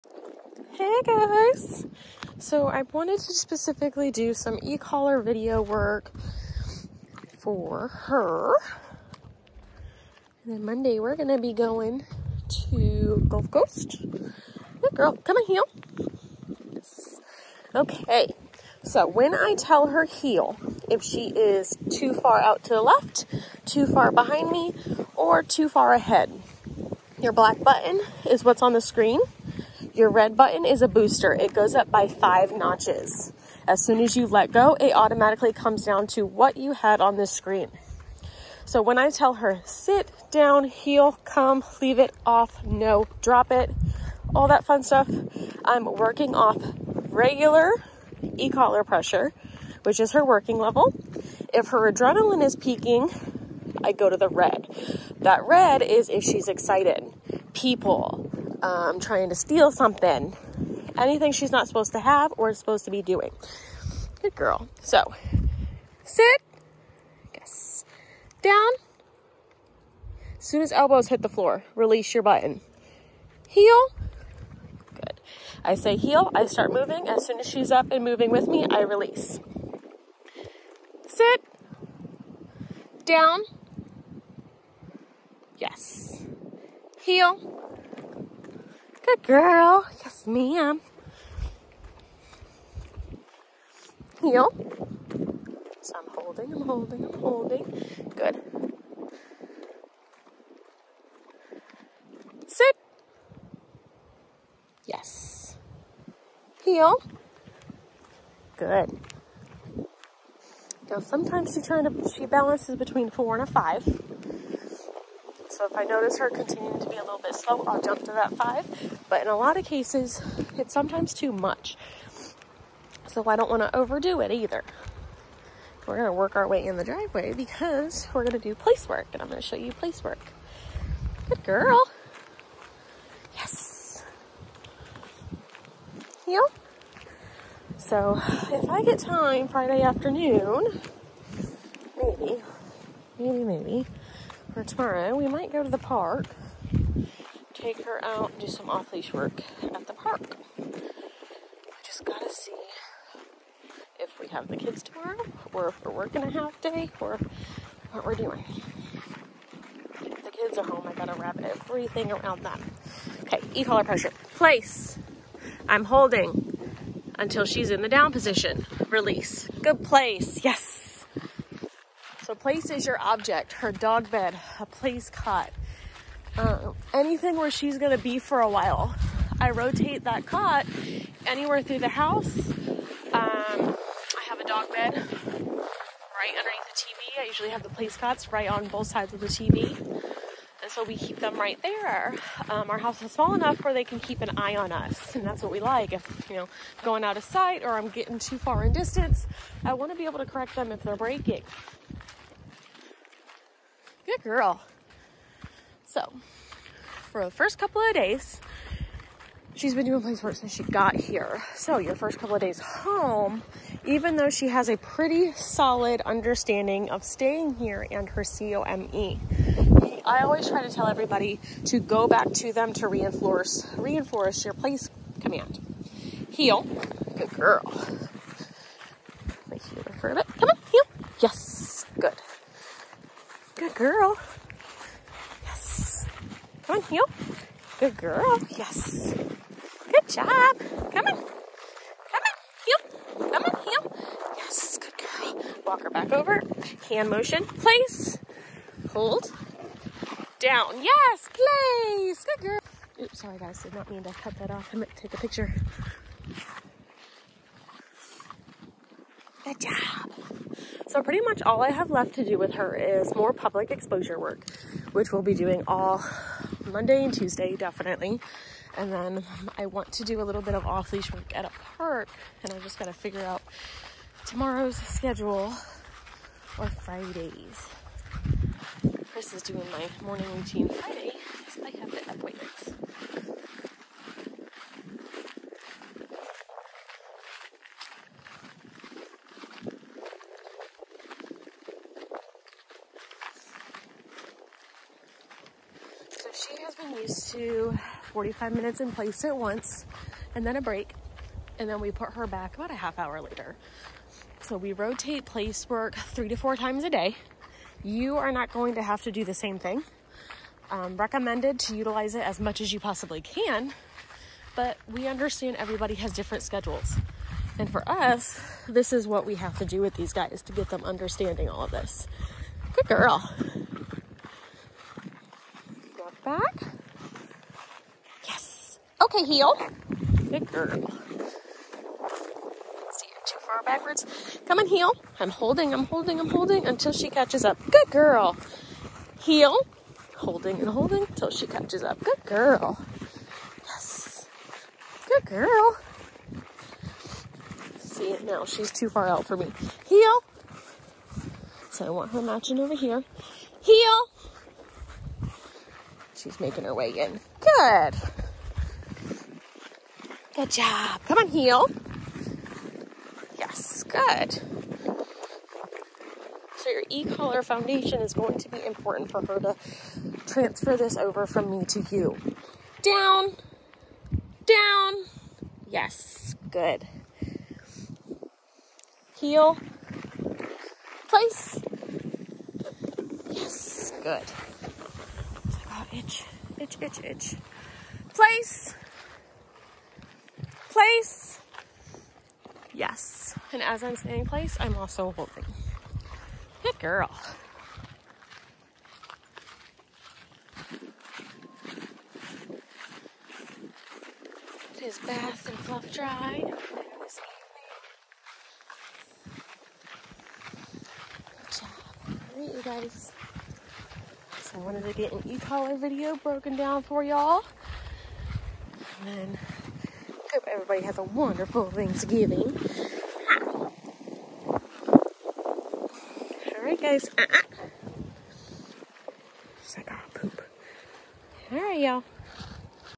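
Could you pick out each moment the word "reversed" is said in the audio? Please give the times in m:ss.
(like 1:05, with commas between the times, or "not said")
not said.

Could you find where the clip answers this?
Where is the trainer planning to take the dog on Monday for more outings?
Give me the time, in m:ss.
0:13.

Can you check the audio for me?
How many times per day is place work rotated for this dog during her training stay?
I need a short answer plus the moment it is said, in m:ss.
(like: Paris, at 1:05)
3 to 4, at 5:05.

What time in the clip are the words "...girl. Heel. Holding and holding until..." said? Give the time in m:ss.
5:37.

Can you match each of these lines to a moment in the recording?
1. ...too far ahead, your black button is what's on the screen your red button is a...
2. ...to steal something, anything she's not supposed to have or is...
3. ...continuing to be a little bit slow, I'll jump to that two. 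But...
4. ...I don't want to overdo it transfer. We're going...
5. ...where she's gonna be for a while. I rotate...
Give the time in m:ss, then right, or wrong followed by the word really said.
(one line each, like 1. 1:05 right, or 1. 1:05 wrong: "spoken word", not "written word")
1. 0:25 right
2. 0:59 right
3. 1:56 wrong: "five", not "two"
4. 2:03 wrong: "either", not "transfer"
5. 2:57 right.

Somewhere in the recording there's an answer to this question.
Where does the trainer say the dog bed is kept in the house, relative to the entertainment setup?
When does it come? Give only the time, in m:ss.
3:04.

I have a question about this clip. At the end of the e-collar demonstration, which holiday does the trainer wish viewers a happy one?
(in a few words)
Thanksgiving.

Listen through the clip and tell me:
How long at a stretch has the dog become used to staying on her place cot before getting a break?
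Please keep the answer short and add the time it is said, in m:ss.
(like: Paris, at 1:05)
45 minutes, at 4:58.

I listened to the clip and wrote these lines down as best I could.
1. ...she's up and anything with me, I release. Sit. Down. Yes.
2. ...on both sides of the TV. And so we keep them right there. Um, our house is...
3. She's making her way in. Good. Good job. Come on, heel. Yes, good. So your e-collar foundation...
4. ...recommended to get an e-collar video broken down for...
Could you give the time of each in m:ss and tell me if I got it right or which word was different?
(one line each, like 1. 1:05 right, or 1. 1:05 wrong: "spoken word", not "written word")
1. 1:17 wrong: "moving", not "anything"
2. 3:08 right
3. 5:56 right
4. 6:54 wrong: "wanted", not "recommended".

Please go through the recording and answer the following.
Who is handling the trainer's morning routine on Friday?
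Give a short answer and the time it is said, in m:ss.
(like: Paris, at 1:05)
Chris, at 4:39.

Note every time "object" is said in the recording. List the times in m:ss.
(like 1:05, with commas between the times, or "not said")
2:53.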